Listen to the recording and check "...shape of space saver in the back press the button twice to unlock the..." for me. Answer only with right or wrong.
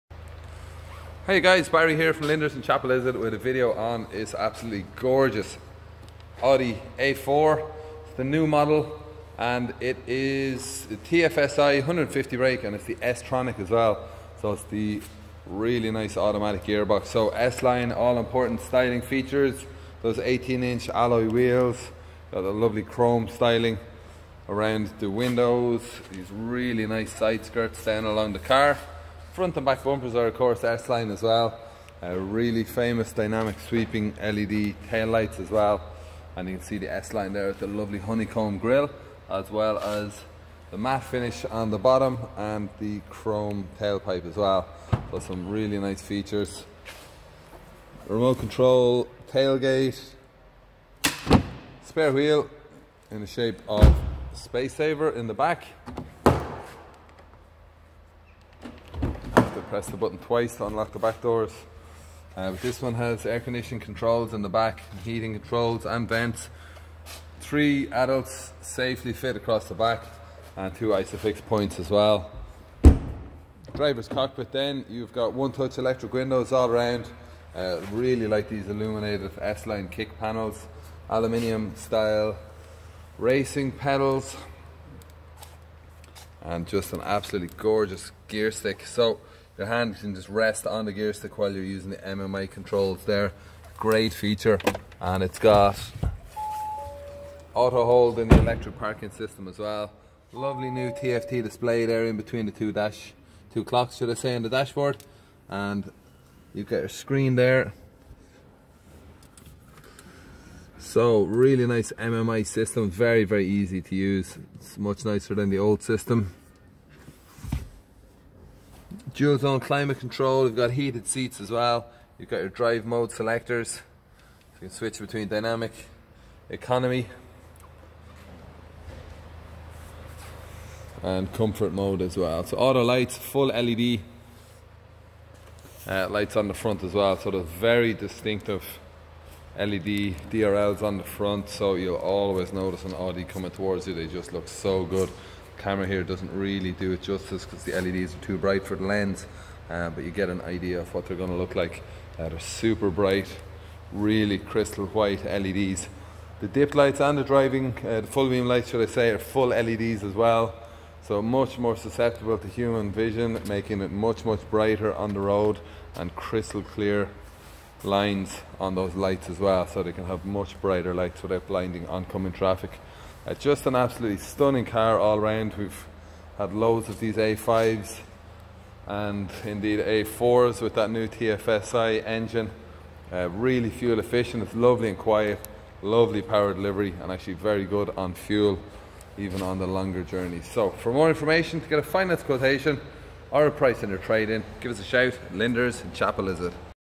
right.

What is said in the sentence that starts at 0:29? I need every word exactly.
Front and back bumpers are of course S-Line as well.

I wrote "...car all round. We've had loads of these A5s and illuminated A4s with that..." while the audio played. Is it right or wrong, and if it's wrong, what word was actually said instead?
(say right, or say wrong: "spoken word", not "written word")
wrong: "indeed", not "illuminated".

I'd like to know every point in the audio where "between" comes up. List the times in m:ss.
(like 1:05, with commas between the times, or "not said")
1:42, 2:04.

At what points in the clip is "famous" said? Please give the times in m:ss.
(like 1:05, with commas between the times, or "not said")
0:32.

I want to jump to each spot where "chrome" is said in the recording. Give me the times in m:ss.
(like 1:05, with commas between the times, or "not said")
0:22, 0:43.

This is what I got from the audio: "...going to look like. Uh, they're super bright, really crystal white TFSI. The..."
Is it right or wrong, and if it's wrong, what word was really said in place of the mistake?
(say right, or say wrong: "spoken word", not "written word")
wrong: "LEDs", not "TFSI".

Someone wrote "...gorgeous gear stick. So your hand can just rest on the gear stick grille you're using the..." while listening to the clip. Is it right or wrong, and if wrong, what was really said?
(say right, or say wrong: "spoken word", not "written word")
wrong: "while", not "grille".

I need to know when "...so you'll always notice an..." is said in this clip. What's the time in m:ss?
2:21.